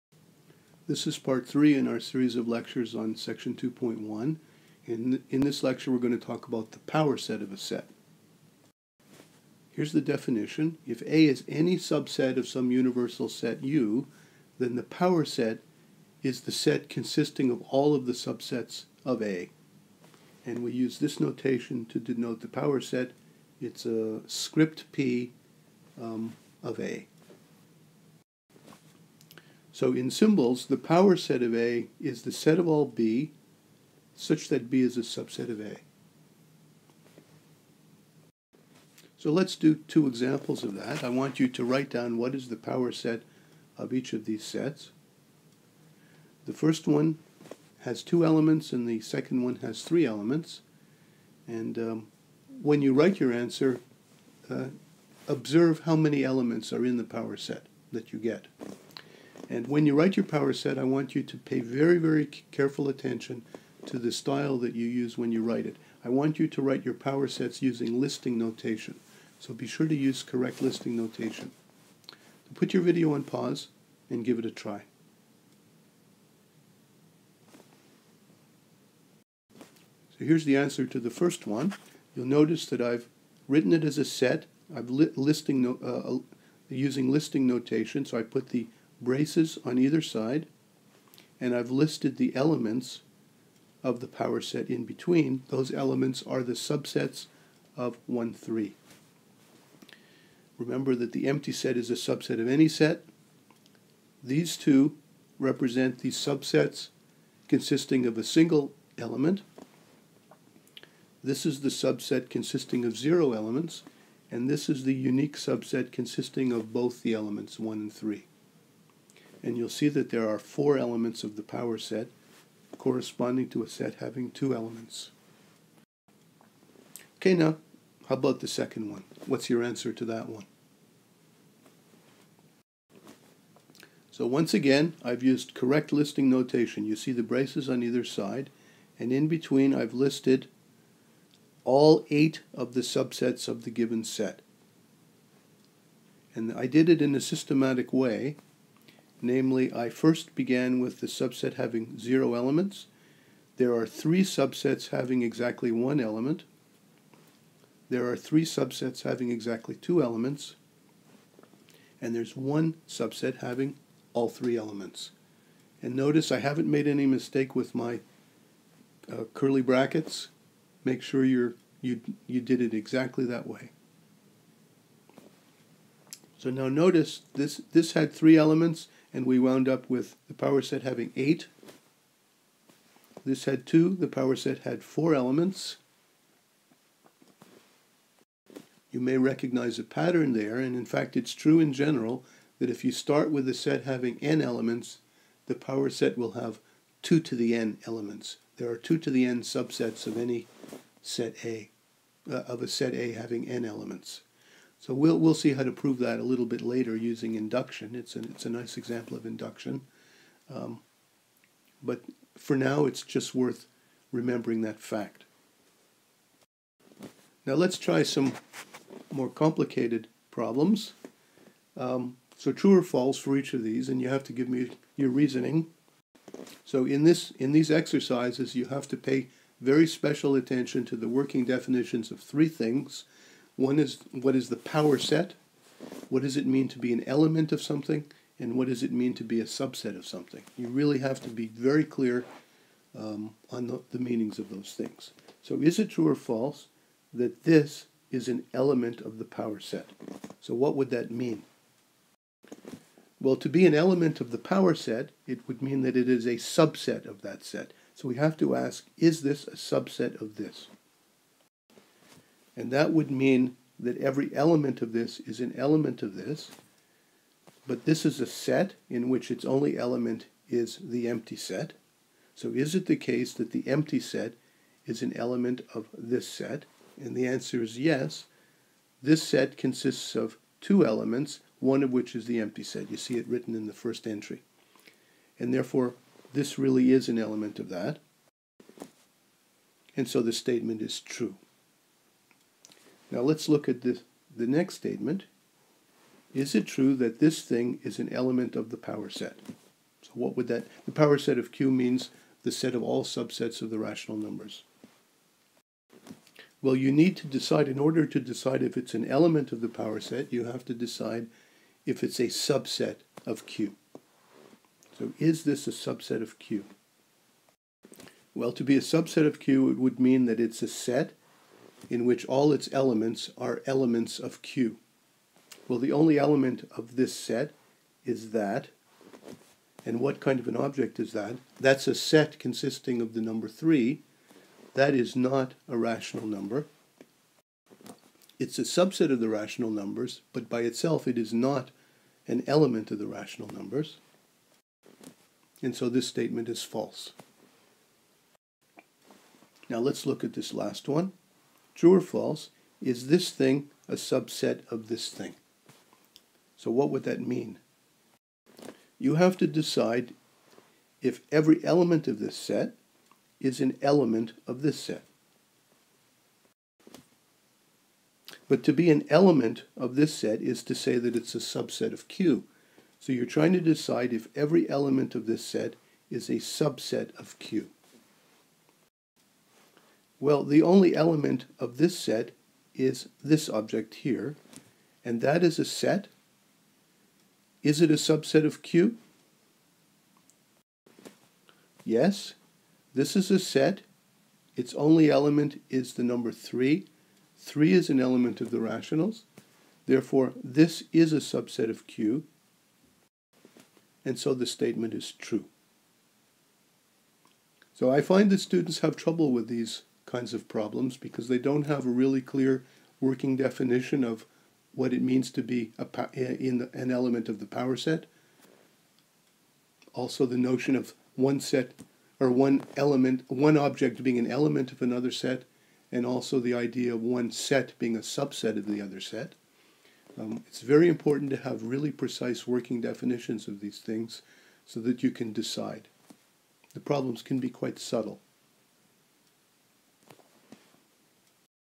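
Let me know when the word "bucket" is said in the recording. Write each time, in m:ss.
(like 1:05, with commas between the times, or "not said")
not said.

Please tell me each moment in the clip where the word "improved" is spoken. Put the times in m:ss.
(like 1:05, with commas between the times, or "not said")
not said.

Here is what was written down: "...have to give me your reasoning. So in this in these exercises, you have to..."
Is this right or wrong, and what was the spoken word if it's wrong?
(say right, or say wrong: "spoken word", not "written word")
right.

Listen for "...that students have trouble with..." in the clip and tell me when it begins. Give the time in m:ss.
6:48.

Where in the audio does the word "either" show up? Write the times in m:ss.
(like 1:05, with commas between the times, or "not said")
1:29, 2:17.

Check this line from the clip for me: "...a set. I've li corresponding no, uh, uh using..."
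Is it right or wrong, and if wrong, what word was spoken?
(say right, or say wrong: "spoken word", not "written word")
wrong: "listing", not "corresponding".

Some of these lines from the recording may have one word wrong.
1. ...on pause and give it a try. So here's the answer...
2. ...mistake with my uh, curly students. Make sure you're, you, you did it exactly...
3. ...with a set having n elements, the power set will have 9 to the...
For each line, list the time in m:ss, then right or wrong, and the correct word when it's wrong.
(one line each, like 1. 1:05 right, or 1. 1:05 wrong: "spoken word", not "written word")
1. 1:13 right
2. 2:47 wrong: "brackets", not "students"
3. 3:13 wrong: "2", not "9".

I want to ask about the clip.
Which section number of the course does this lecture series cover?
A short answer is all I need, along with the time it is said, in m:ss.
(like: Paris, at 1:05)
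2.1, at 0:03.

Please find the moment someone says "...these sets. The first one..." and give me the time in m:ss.
0:44.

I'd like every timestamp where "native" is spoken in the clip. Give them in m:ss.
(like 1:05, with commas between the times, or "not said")
not said.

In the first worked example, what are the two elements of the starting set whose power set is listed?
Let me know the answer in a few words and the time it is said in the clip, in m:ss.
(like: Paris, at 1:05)
1 and 3, at 1:38.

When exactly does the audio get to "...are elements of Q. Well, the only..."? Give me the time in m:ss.
5:23.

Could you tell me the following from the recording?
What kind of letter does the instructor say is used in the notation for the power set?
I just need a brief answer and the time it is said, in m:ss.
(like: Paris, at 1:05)
Script P, at 0:24.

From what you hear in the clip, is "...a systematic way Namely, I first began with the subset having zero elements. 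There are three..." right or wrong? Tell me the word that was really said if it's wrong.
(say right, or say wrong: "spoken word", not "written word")
right.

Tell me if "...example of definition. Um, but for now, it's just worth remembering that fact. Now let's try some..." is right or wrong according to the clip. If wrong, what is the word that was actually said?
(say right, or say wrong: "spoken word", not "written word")
wrong: "induction", not "definition".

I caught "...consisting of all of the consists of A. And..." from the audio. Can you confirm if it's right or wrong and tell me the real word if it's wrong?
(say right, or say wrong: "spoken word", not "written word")
wrong: "subsets", not "consists".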